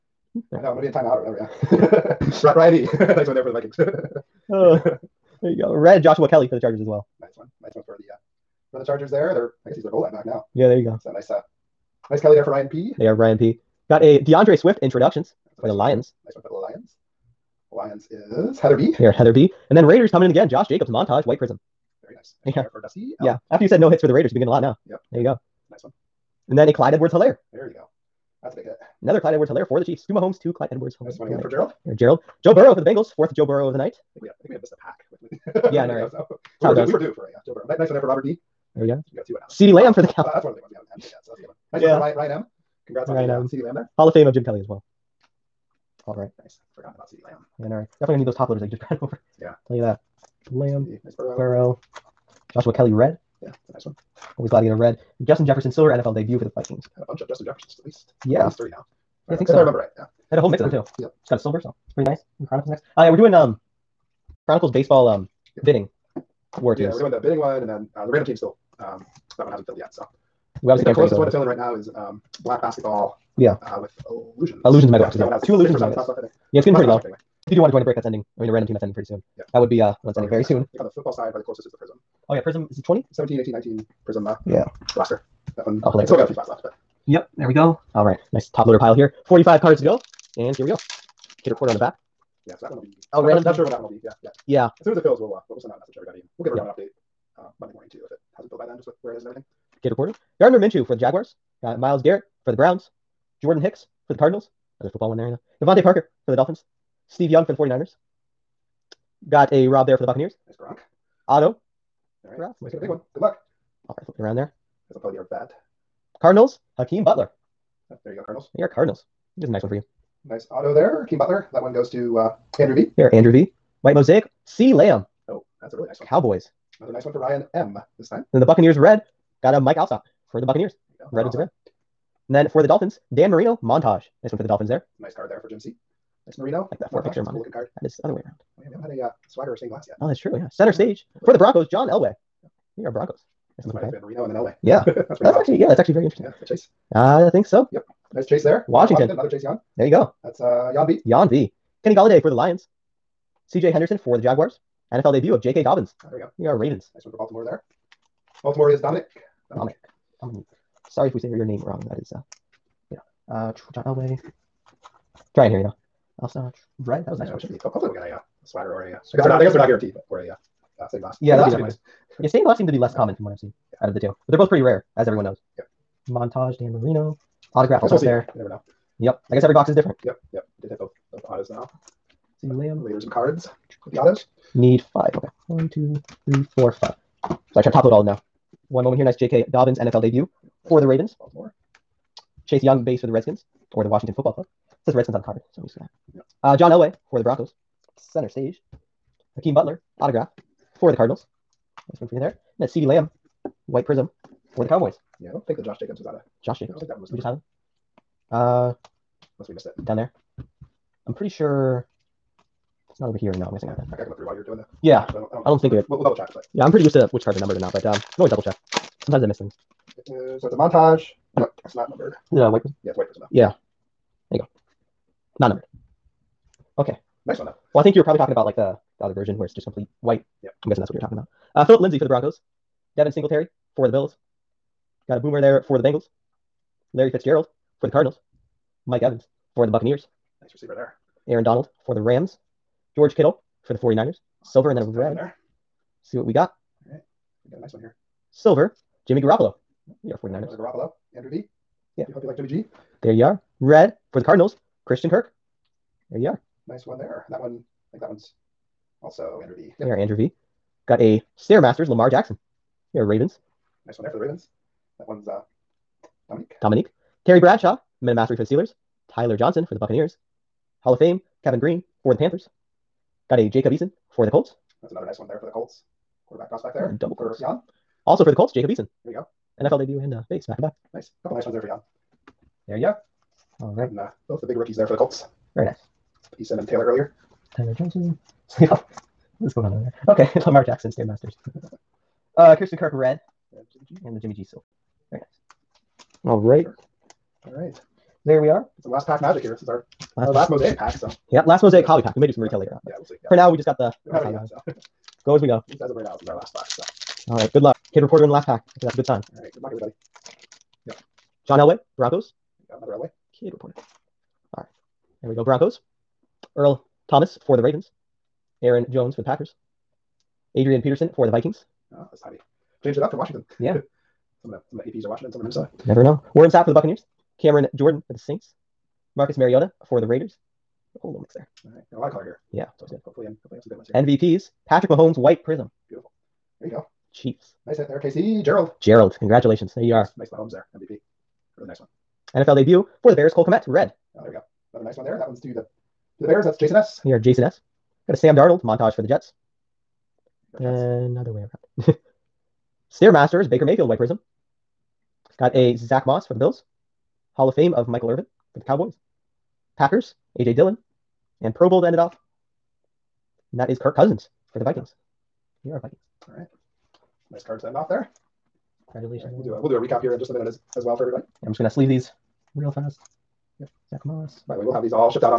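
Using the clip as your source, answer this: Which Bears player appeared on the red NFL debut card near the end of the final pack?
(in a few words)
Cole Kmet.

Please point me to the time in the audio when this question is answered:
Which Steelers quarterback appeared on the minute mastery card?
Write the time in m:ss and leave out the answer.
4:27.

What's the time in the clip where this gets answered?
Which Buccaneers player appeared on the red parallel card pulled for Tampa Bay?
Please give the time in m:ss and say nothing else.
2:09.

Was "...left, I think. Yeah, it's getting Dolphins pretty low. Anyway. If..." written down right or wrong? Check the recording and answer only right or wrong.
wrong.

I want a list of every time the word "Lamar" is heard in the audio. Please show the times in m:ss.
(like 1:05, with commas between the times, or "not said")
4:21, 4:50.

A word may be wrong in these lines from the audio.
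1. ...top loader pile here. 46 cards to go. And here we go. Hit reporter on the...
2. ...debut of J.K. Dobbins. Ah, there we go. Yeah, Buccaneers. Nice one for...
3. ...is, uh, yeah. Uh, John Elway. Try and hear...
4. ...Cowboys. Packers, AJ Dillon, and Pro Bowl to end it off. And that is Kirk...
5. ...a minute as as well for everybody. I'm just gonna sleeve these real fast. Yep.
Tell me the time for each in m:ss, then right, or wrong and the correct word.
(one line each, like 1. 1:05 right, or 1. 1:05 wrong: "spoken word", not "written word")
1. 1:28 wrong: "45", not "46"
2. 2:35 wrong: "Ravens", not "Buccaneers"
3. 2:41 right
4. 5:58 right
5. 6:10 right.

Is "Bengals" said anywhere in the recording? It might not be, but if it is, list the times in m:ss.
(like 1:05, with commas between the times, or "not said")
0:32, 3:55.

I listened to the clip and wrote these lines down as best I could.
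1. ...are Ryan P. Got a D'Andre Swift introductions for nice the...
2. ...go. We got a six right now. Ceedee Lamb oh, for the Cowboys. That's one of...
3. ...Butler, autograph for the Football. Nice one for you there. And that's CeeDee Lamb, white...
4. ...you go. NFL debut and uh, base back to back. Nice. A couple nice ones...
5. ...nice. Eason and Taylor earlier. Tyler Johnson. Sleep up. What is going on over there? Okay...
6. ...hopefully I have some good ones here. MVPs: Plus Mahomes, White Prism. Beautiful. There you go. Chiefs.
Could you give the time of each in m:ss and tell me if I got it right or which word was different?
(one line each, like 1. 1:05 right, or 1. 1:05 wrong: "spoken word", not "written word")
1. 0:13 right
2. 0:38 wrong: "two", not "six"
3. 3:19 wrong: "Cardinals", not "Football"
4. 4:39 right
5. 4:45 right
6. 5:33 wrong: "Patrick", not "Plus".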